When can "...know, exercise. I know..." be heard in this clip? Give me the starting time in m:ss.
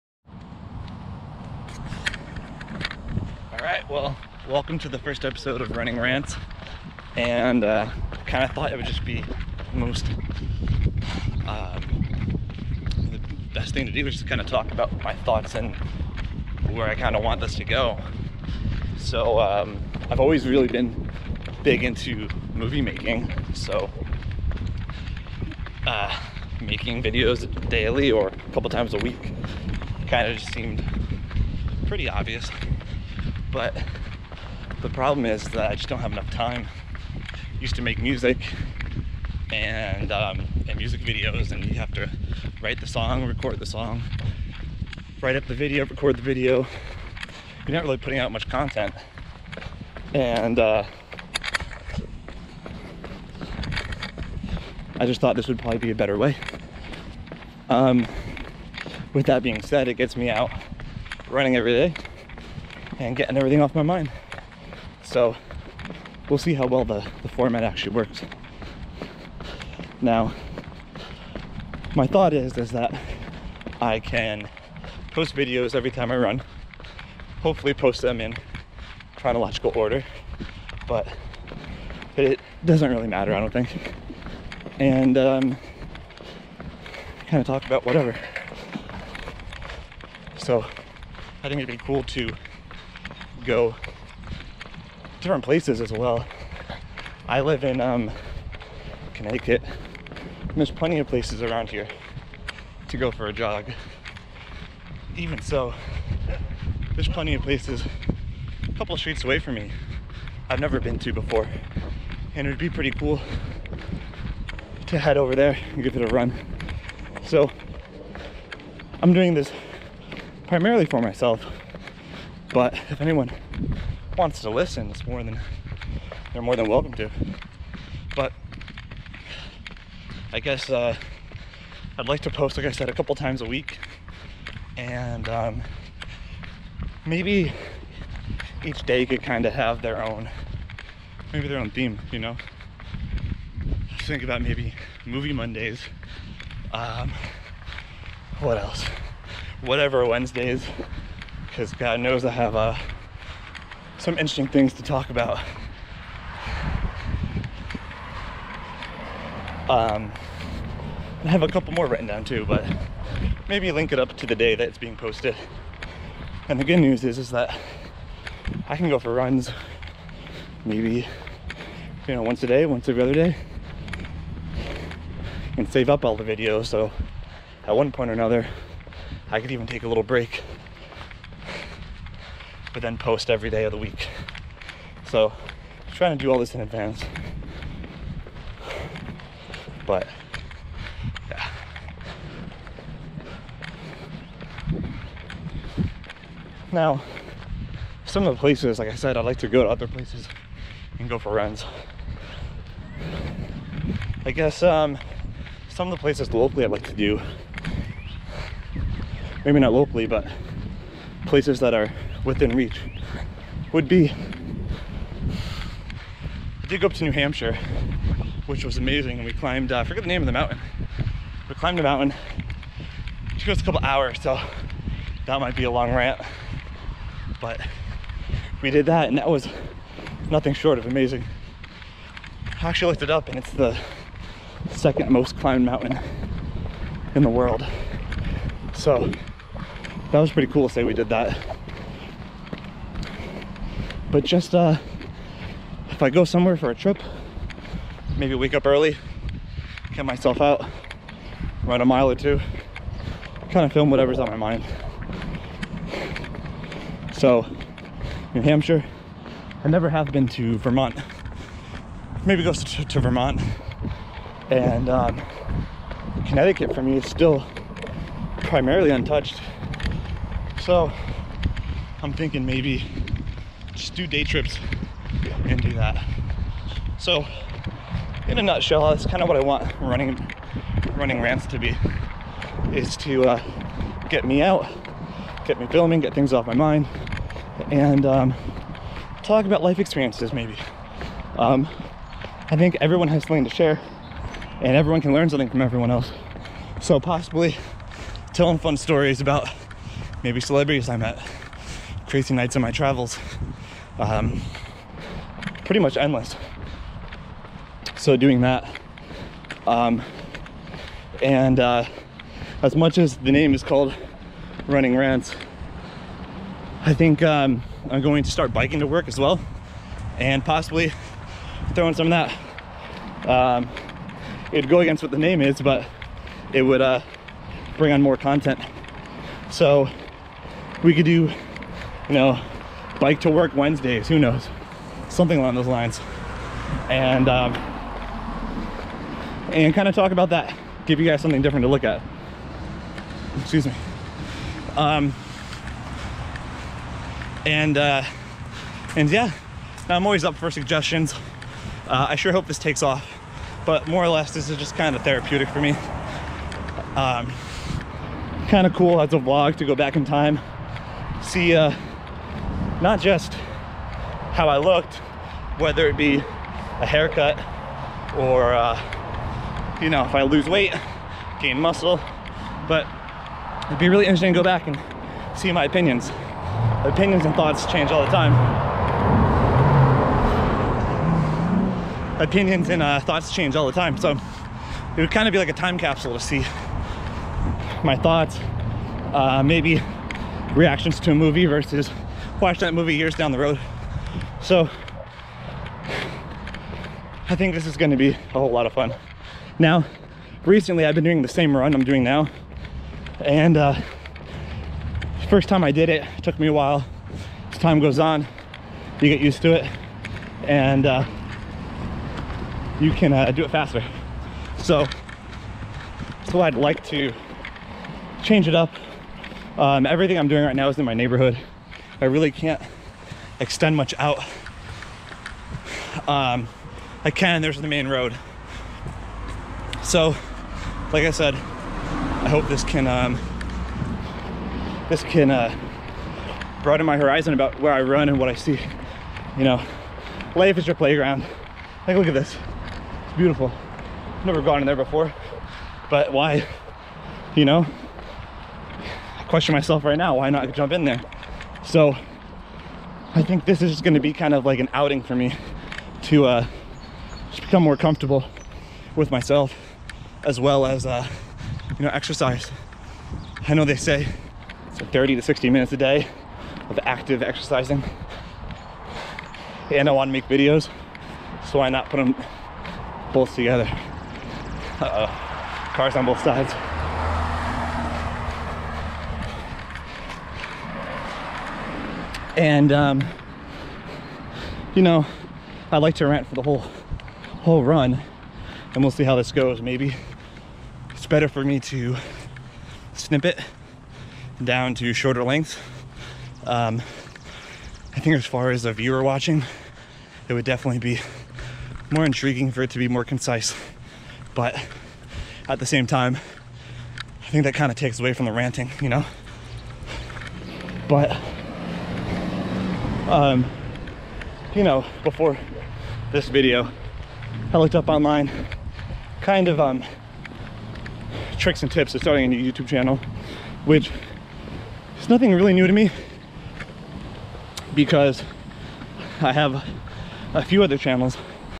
7:41.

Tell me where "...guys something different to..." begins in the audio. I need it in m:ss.
5:41.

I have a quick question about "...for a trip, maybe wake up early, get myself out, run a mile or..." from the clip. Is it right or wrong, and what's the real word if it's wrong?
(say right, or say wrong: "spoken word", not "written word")
right.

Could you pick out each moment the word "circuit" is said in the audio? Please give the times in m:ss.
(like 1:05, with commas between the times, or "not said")
not said.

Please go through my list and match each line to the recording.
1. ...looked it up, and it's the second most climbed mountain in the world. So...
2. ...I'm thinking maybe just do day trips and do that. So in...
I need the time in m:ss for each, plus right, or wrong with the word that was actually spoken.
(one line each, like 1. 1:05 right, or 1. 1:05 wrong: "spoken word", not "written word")
1. 3:52 right
2. 4:32 right.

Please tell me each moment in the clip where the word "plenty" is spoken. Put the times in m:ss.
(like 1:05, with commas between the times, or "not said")
1:40, 1:47.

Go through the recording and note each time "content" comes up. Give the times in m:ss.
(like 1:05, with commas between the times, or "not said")
0:48, 5:28.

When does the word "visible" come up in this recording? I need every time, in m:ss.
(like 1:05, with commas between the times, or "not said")
not said.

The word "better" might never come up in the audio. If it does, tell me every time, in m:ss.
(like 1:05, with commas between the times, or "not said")
0:55, 8:11.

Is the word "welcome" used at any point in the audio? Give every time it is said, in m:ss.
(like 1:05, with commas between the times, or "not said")
0:04, 2:06.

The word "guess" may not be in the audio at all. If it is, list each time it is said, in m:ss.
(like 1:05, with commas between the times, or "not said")
2:10, 3:24.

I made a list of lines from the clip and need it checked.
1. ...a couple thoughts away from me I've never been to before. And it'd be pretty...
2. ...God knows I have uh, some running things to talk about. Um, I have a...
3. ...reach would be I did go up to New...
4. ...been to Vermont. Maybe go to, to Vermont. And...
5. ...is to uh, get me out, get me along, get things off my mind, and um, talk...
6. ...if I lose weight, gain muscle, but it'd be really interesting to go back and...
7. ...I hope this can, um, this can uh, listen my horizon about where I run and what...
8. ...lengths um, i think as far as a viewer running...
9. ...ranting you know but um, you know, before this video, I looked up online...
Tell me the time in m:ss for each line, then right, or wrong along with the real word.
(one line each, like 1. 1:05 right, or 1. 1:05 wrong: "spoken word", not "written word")
1. 1:48 wrong: "streets", not "thoughts"
2. 2:31 wrong: "interesting", not "running"
3. 3:32 right
4. 4:20 right
5. 4:42 wrong: "filming", not "along"
6. 6:10 right
7. 7:11 wrong: "broaden", not "listen"
8. 8:15 wrong: "watching", not "running"
9. 8:28 right.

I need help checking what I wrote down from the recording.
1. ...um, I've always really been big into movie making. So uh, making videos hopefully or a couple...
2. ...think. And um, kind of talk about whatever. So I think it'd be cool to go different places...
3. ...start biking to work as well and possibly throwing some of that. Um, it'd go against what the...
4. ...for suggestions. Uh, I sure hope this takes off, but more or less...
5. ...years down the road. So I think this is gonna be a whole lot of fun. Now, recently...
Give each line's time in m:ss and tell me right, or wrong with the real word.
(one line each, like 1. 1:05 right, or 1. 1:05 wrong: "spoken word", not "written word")
1. 0:19 wrong: "daily", not "hopefully"
2. 1:23 right
3. 5:18 right
4. 5:50 right
5. 6:32 right.